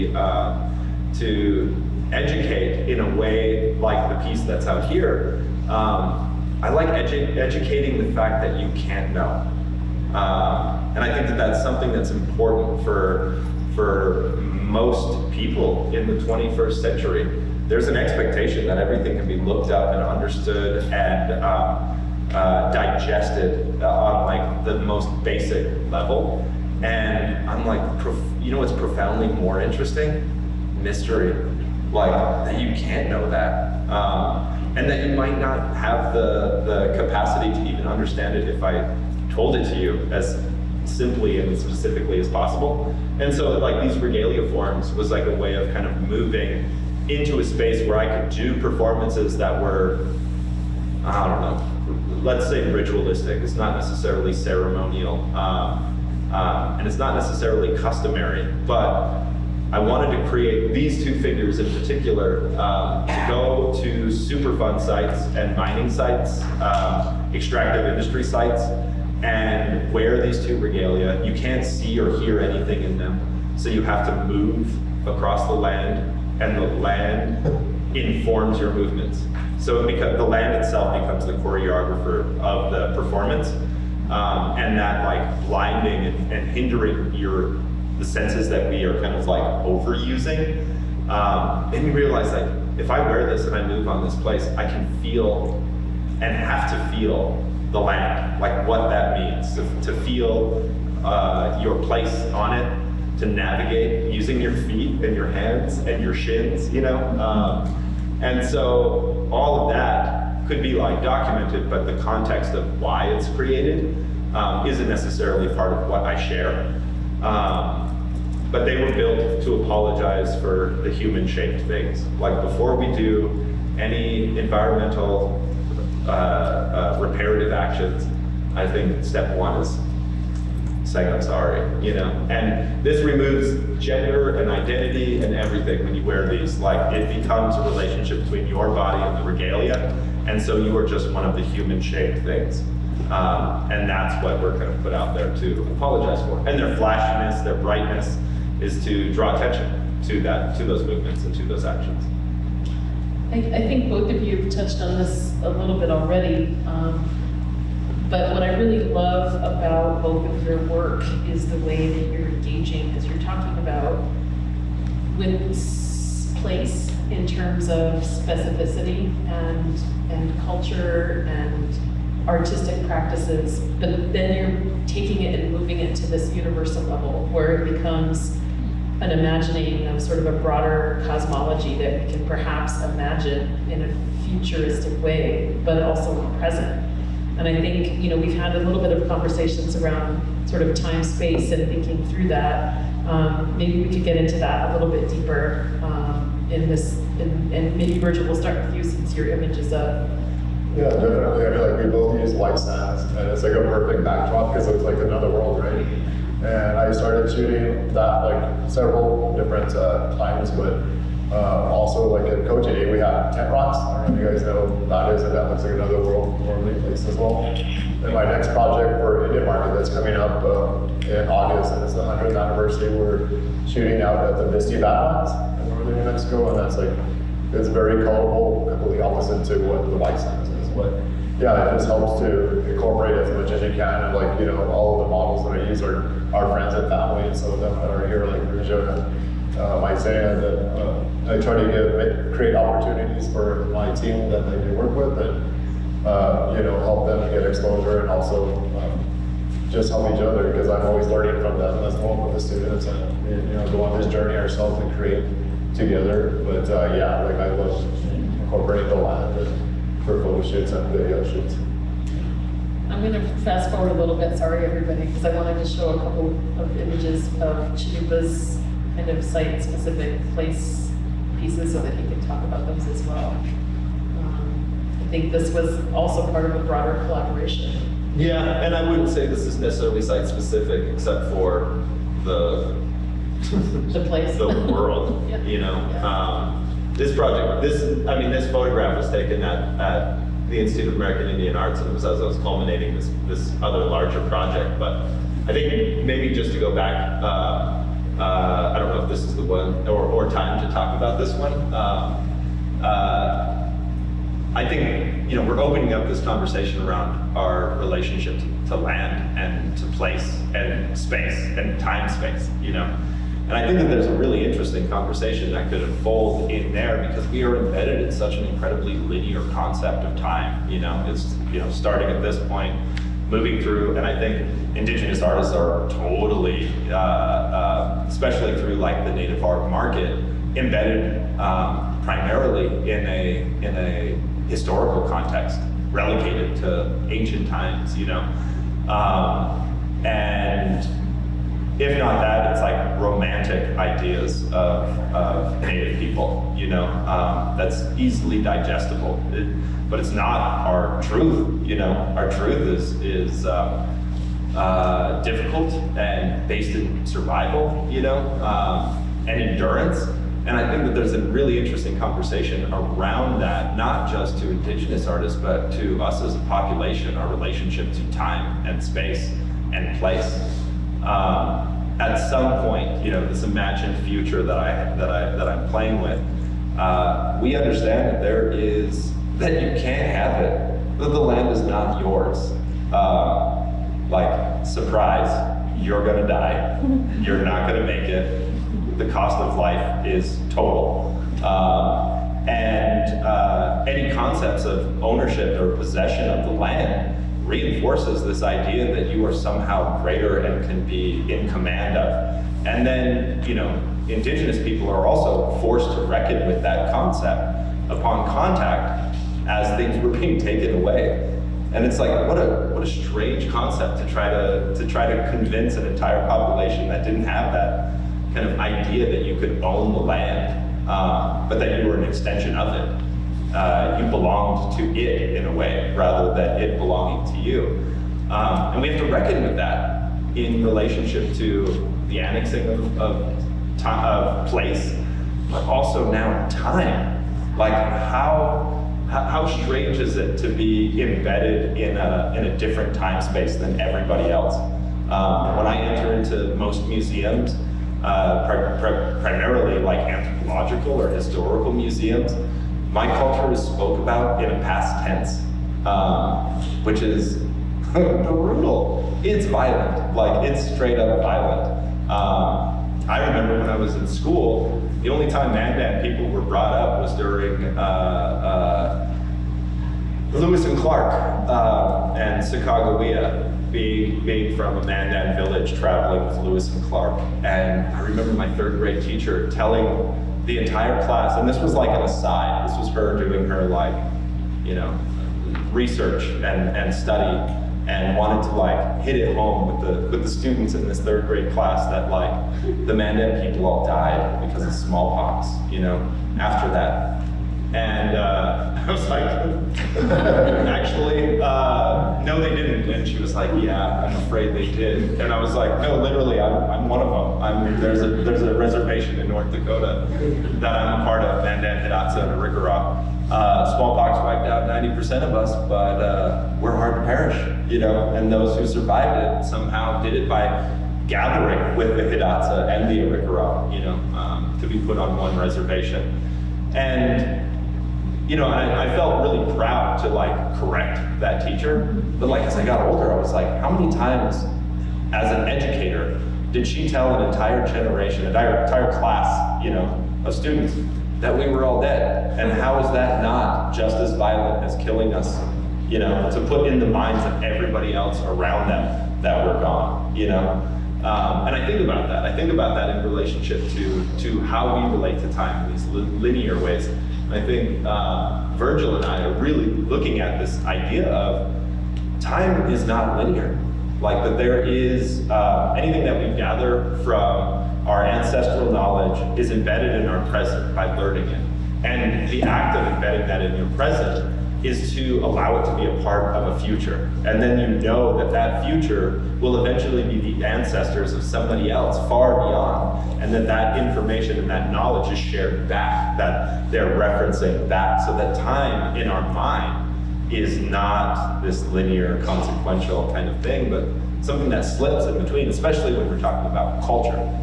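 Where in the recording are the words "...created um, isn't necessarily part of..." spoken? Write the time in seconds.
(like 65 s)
113 s.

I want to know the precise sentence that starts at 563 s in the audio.
Like that there is uh, anything that we gather from our ancestral knowledge is embedded in our present by learning it.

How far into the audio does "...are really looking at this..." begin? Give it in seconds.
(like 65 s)
559 s.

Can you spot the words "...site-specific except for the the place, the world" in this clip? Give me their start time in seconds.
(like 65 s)
280 s.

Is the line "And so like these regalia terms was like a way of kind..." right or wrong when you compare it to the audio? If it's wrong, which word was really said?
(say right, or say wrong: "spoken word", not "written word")
wrong: "forms", not "terms".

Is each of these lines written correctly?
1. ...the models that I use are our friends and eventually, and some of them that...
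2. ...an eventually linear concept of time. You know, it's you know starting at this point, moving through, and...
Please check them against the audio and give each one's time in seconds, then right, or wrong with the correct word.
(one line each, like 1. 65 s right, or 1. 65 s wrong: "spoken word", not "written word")
1. 235 s wrong: "family", not "eventually"
2. 318 s wrong: "incredibly", not "eventually".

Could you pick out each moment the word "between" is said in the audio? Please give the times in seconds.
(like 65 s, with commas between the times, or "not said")
138 s, 595 s.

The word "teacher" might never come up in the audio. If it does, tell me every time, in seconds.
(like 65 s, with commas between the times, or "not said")
479 s, 531 s.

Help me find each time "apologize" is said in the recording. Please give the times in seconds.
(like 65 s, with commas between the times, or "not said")
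119 s, 145 s.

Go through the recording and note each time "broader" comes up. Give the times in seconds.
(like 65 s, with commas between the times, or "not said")
180 s, 276 s.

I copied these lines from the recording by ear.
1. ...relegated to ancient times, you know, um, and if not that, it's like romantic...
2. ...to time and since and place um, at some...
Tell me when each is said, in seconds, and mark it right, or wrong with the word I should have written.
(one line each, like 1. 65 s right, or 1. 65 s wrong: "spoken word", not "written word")
1. 335 s right
2. 367 s wrong: "space", not "since".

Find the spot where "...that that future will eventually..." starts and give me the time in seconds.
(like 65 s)
578 s.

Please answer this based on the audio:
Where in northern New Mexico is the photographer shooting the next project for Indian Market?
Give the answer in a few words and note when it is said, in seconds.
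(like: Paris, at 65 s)
Bisti Badlands, at 224 s.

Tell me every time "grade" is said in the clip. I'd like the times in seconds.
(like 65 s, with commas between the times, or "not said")
478 s, 491 s.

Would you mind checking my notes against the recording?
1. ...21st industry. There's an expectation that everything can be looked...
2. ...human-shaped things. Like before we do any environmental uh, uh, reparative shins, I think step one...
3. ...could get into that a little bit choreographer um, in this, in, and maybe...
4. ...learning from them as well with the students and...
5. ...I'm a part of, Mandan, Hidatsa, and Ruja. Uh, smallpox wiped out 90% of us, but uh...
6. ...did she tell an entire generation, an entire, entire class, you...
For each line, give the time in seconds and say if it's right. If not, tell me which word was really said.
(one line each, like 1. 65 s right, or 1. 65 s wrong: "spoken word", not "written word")
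1. 16 s wrong: "century", not "industry"
2. 120 s wrong: "actions", not "shins"
3. 193 s wrong: "deeper", not "choreographer"
4. 251 s right
5. 510 s wrong: "Ricorah", not "Ruja"
6. 536 s right.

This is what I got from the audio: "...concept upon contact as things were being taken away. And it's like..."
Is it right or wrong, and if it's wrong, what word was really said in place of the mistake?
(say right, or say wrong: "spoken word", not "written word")
right.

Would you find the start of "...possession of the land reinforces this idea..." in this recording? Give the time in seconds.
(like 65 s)
395 s.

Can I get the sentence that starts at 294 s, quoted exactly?
But I think maybe just to go back.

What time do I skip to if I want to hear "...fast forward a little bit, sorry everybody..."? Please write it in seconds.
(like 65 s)
263 s.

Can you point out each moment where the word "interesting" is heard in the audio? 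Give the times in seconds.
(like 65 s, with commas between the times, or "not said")
29 s, 314 s, 361 s.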